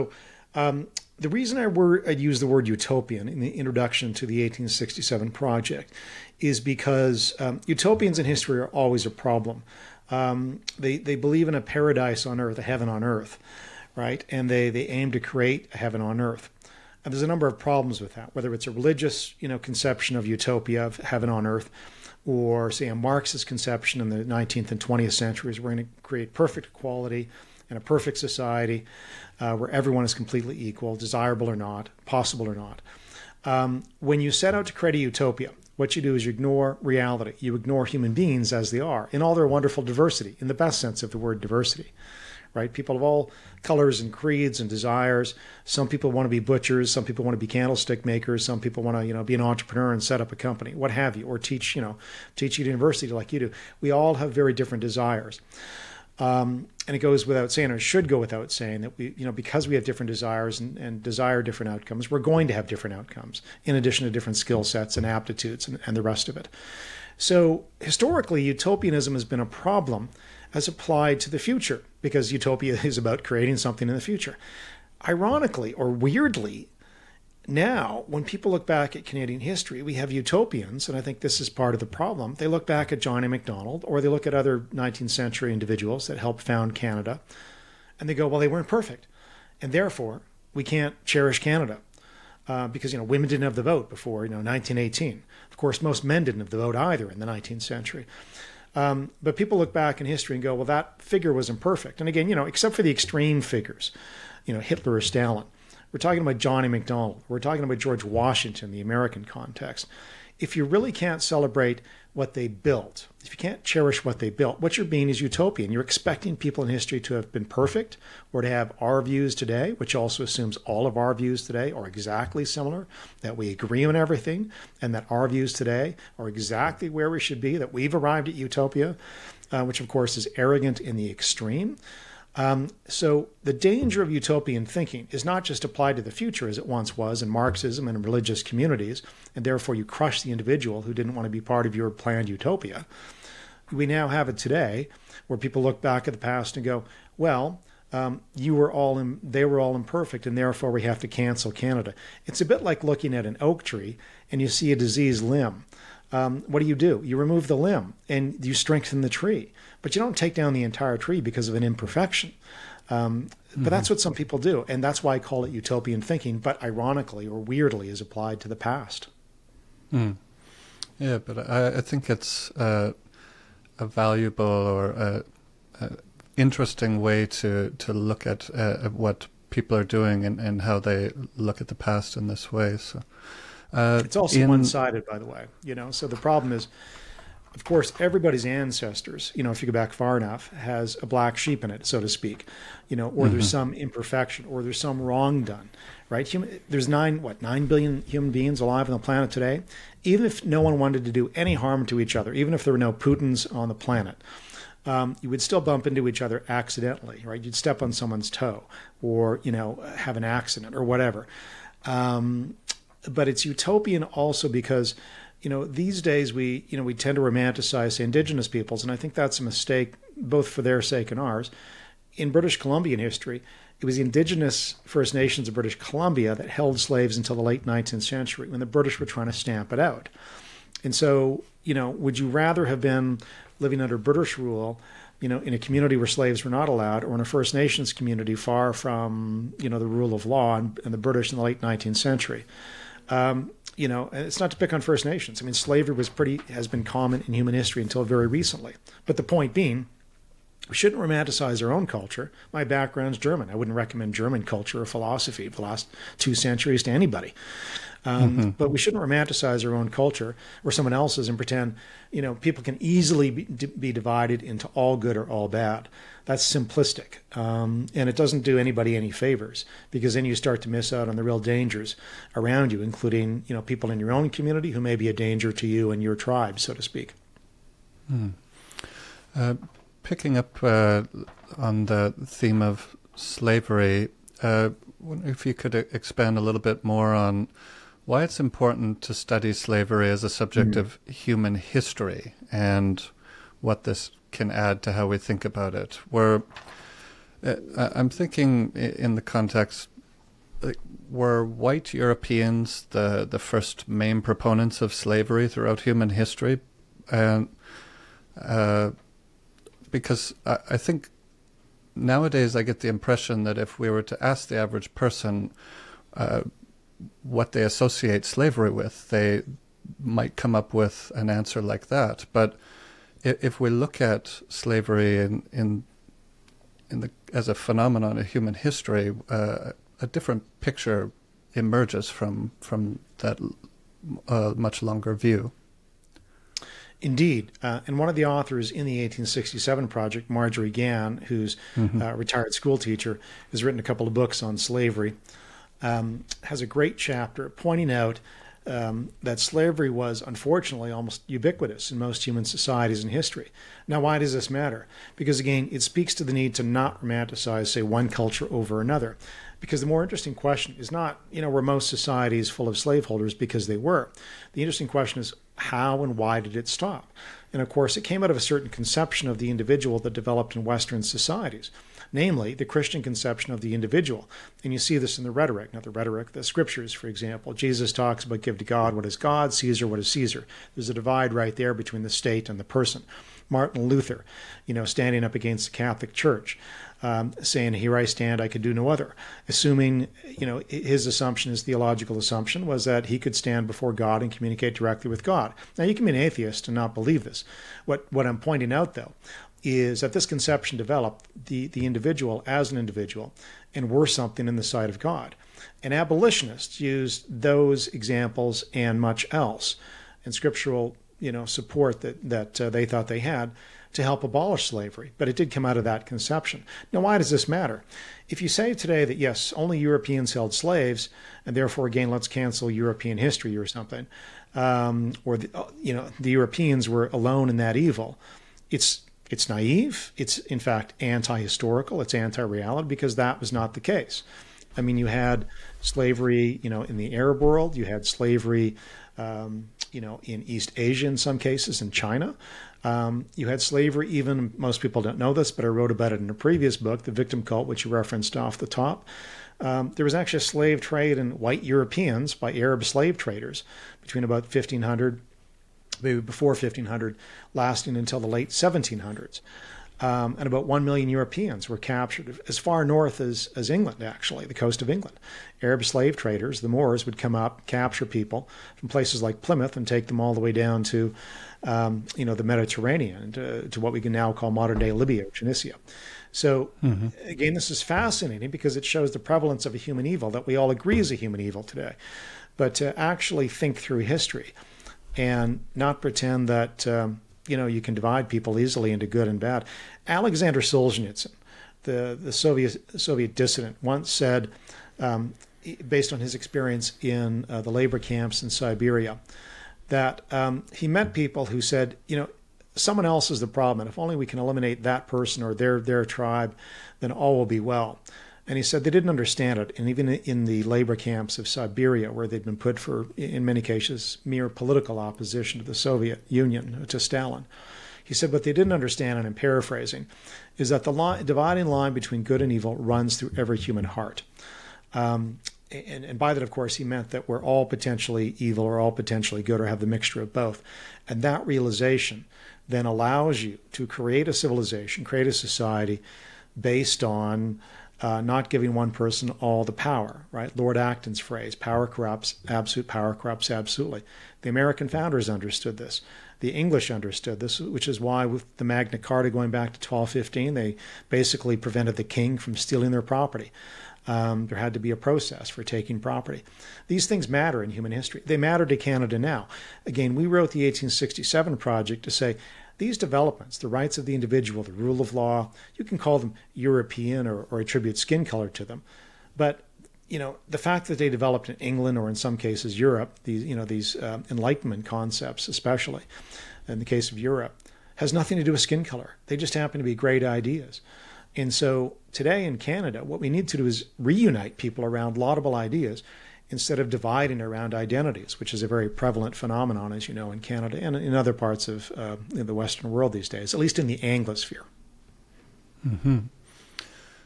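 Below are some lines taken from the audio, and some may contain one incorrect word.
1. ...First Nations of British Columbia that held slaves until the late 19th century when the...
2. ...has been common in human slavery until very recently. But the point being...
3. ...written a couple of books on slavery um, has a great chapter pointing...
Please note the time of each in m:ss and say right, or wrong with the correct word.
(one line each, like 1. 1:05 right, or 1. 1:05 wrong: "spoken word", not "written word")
1. 3:44 right
2. 4:06 wrong: "history", not "slavery"
3. 5:43 right.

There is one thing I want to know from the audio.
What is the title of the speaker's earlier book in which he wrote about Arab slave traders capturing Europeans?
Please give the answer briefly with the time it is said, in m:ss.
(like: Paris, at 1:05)
The Victim Cult, at 7:27.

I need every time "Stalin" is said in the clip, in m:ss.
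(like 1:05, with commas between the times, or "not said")
1:45, 8:36.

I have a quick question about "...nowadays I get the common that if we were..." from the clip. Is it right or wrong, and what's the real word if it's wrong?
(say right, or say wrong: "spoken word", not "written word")
wrong: "impression", not "common".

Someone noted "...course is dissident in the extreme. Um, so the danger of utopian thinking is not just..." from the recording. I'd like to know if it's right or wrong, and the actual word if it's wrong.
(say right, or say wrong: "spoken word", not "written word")
wrong: "arrogant", not "dissident".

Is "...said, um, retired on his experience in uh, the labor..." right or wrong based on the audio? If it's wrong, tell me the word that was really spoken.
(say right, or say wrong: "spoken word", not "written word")
wrong: "based", not "retired".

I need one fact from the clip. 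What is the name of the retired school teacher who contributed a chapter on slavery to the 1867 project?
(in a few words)
Marjorie Gann.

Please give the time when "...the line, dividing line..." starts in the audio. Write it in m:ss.
8:40.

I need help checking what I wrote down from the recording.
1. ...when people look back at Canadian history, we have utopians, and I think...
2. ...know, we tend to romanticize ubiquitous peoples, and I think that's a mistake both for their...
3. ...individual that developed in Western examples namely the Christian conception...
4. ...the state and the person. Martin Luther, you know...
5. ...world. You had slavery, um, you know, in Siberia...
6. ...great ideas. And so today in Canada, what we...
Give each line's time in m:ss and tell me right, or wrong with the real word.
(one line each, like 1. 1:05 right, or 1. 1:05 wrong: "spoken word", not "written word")
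1. 1:18 right
2. 3:36 wrong: "indigenous", not "ubiquitous"
3. 6:09 wrong: "societies", not "examples"
4. 6:22 right
5. 7:17 wrong: "East", not "Siberia"
6. 9:39 right.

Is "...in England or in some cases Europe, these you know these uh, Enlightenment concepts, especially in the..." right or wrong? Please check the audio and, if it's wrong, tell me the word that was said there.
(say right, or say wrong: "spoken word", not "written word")
right.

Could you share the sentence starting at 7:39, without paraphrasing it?
Um, and about 1 million Europeans were captured as far north as, as England, actually, the coast of England.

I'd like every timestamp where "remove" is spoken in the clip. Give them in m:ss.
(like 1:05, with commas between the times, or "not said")
2:37.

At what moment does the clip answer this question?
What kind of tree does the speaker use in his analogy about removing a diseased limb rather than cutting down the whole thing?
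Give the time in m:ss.
2:33.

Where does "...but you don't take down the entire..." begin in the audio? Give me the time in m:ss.
2:39.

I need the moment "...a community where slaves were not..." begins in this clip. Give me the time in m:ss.
3:55.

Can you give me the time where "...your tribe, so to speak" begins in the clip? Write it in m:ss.
4:36.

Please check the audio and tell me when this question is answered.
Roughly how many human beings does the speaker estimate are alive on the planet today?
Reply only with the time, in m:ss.
3:17.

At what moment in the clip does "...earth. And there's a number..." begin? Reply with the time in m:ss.
0:16.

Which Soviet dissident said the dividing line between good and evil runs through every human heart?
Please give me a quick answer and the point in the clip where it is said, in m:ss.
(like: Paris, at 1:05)
Alexander Solzhenitsyn, at 8:10.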